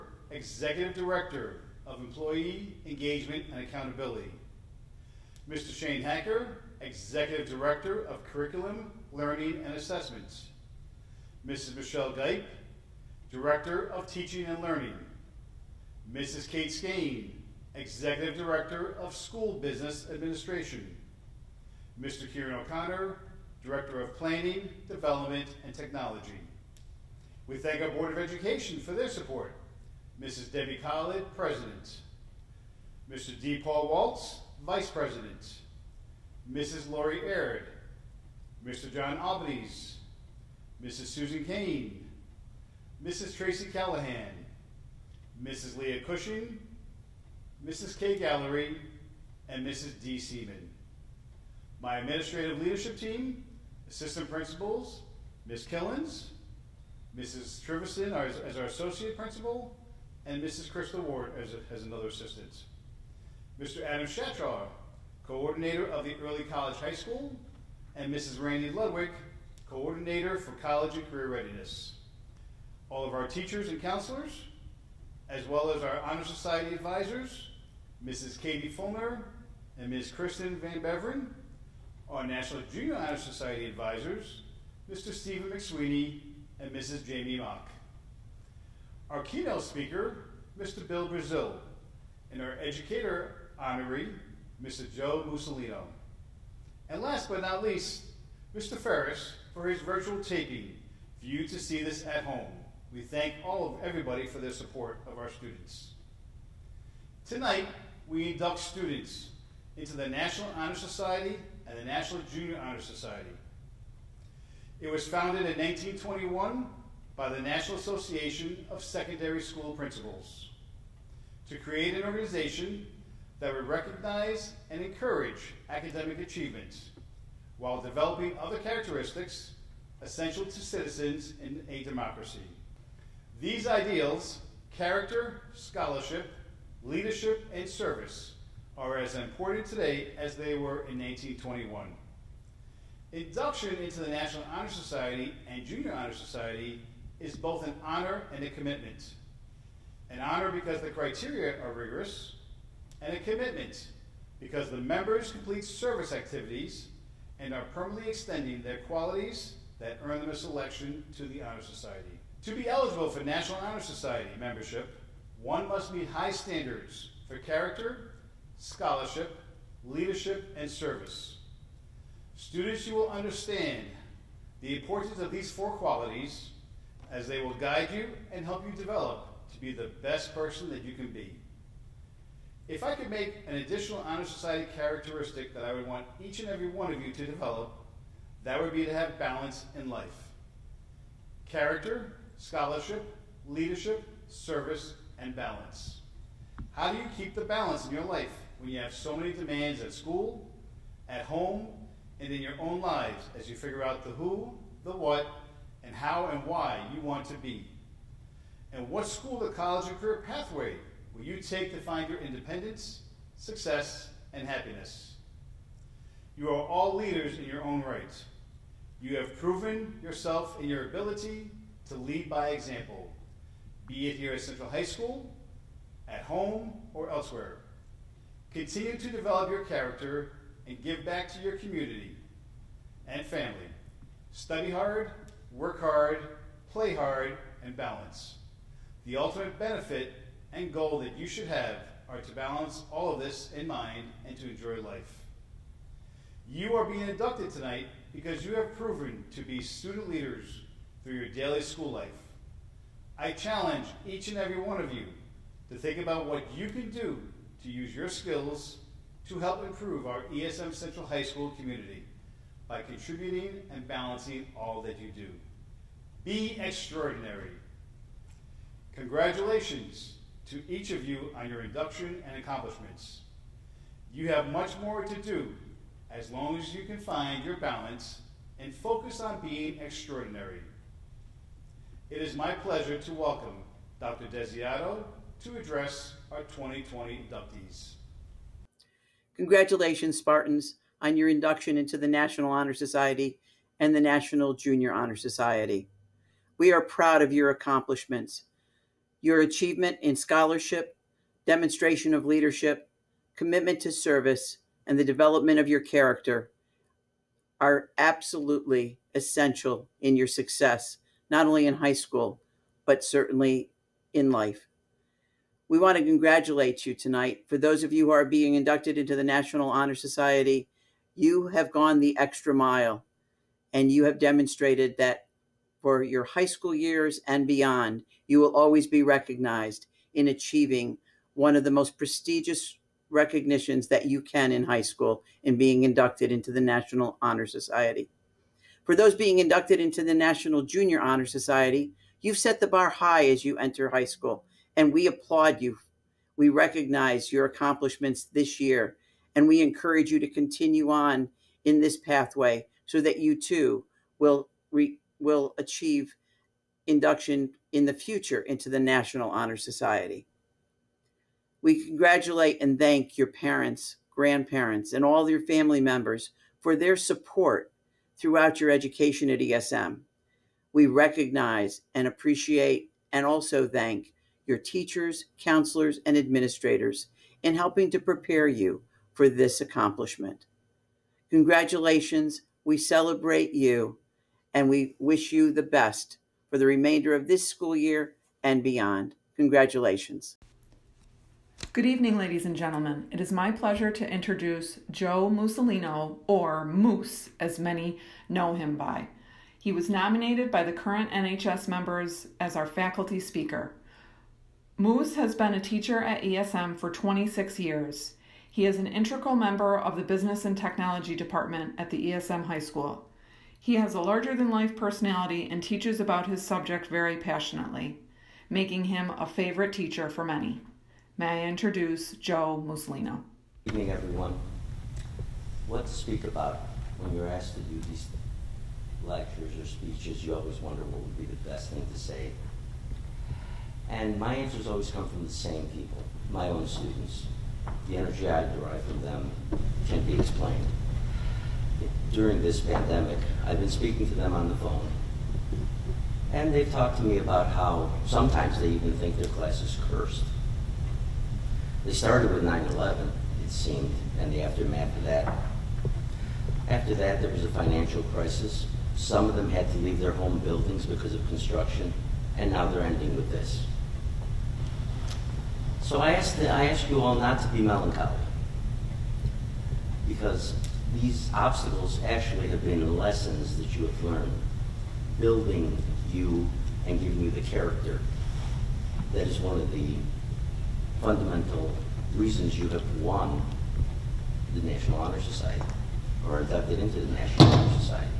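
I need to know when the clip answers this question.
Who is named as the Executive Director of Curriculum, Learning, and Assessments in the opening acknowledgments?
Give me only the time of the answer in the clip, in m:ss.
0:11.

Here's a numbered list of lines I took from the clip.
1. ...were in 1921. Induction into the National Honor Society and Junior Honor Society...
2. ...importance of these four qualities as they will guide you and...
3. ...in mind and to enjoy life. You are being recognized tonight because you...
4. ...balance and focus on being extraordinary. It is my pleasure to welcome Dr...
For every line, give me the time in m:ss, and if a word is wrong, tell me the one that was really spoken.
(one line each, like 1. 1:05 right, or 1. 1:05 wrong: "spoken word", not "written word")
1. 2:20 right
2. 2:54 right
3. 4:03 wrong: "inducted", not "recognized"
4. 4:37 right.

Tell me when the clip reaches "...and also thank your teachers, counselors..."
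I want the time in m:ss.
6:13.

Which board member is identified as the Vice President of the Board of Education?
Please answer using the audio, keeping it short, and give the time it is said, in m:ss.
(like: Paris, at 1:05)
D. Paul Waltz, at 0:33.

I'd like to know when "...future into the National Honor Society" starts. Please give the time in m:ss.
5:57.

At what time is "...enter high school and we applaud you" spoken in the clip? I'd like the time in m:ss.
5:43.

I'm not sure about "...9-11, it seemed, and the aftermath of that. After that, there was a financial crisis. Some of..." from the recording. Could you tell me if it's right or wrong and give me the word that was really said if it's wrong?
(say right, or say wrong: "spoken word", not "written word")
right.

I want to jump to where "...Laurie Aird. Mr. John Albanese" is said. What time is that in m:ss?
0:36.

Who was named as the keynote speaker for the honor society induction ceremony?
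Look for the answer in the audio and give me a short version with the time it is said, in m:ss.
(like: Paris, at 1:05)
Bill Brazil, at 1:30.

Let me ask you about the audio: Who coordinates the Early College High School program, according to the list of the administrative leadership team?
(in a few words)
Adam Shatraw.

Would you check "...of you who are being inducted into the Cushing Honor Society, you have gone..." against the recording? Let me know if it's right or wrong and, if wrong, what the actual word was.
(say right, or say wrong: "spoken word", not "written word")
wrong: "National", not "Cushing".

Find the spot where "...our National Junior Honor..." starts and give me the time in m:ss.
1:22.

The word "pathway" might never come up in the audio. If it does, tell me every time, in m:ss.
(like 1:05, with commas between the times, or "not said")
3:30, 5:51.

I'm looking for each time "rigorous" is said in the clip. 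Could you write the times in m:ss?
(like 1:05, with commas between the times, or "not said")
2:31.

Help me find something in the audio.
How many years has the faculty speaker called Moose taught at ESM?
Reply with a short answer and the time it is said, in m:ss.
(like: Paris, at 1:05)
26, at 6:46.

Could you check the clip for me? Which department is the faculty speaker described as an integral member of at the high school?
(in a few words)
Business and Technology.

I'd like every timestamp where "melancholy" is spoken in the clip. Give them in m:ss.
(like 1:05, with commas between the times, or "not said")
7:47.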